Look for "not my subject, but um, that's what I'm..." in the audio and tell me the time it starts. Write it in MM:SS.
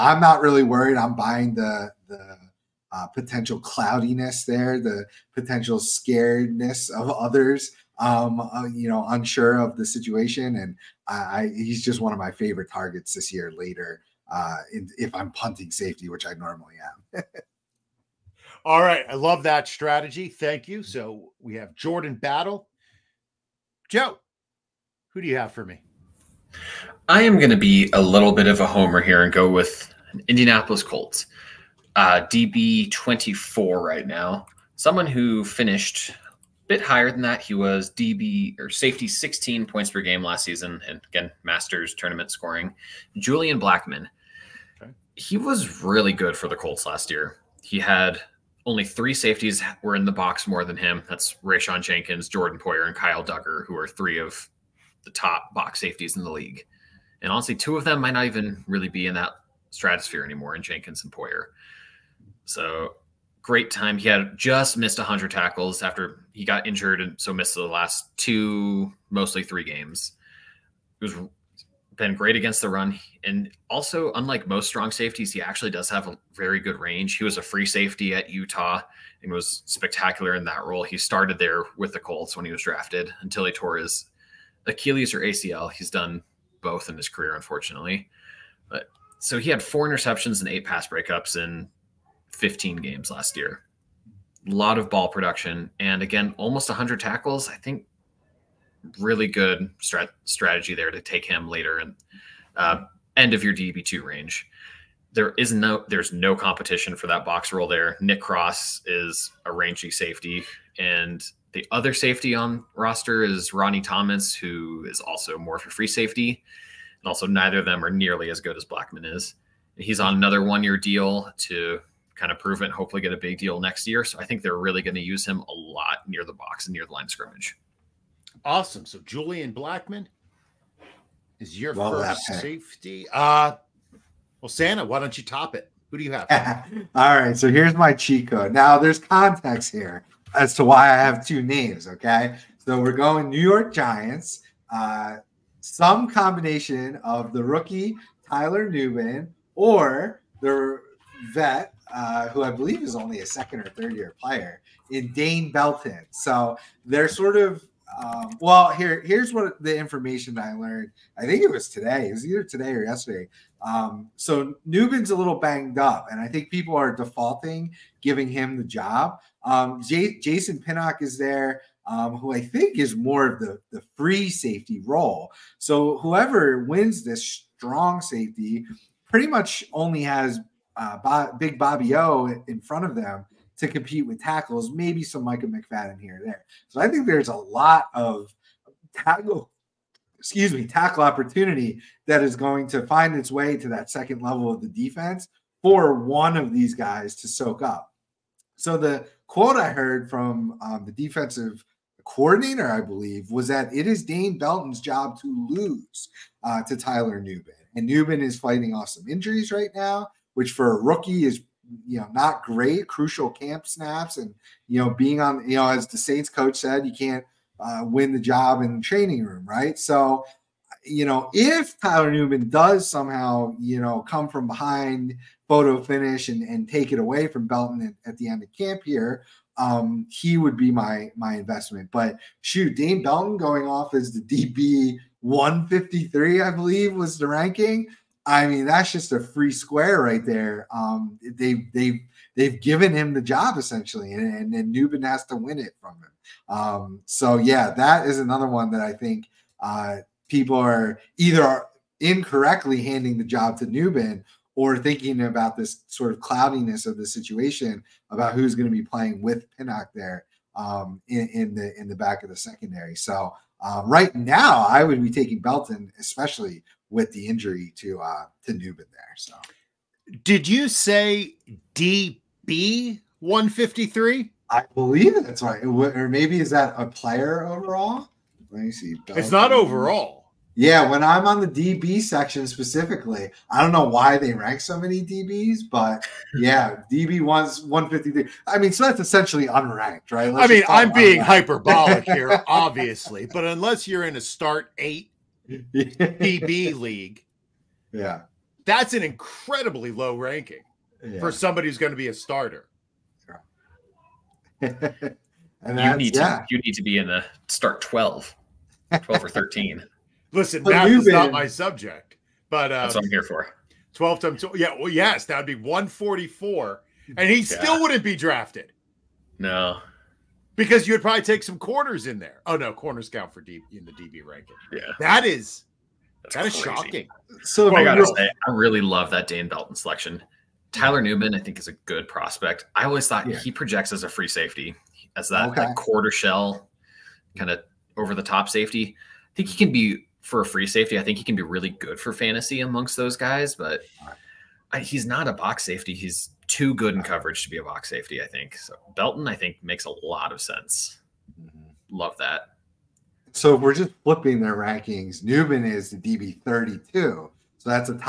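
05:11.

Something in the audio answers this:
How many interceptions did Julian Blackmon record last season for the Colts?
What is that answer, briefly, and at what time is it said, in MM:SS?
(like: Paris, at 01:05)
4, at 01:29.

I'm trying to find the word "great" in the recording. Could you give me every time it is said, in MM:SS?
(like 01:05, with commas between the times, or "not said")
01:03, 01:12, 03:32.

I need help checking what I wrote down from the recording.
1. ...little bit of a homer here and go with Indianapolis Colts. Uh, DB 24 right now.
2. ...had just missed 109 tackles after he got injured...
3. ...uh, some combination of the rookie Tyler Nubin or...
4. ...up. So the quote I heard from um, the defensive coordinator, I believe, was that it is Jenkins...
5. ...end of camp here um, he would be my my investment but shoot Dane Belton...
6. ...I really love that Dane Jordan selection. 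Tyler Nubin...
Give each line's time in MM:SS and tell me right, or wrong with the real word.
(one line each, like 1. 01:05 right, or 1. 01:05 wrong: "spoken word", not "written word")
1. 00:28 right
2. 01:04 wrong: "100", not "109"
3. 02:24 right
4. 03:17 wrong: "Dane", not "Jenkins"
5. 03:48 right
6. 05:28 wrong: "Belton", not "Jordan".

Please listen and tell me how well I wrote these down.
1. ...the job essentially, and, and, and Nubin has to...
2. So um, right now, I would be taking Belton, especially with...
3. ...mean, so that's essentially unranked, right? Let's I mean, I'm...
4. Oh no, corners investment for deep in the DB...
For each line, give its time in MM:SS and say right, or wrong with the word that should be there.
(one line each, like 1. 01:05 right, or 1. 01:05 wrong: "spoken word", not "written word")
1. 04:03 right
2. 04:22 right
3. 04:48 right
4. 05:22 wrong: "count", not "investment".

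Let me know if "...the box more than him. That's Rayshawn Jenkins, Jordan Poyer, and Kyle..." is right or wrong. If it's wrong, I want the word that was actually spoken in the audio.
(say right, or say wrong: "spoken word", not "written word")
right.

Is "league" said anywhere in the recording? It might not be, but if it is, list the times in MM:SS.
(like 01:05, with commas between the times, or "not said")
00:56, 04:56.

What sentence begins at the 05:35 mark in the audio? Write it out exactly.
quarter shell, kind of over the top safety.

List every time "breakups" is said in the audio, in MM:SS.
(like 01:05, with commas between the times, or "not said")
01:30.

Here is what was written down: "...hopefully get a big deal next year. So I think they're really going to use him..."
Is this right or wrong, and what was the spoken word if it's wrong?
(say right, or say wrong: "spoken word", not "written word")
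right.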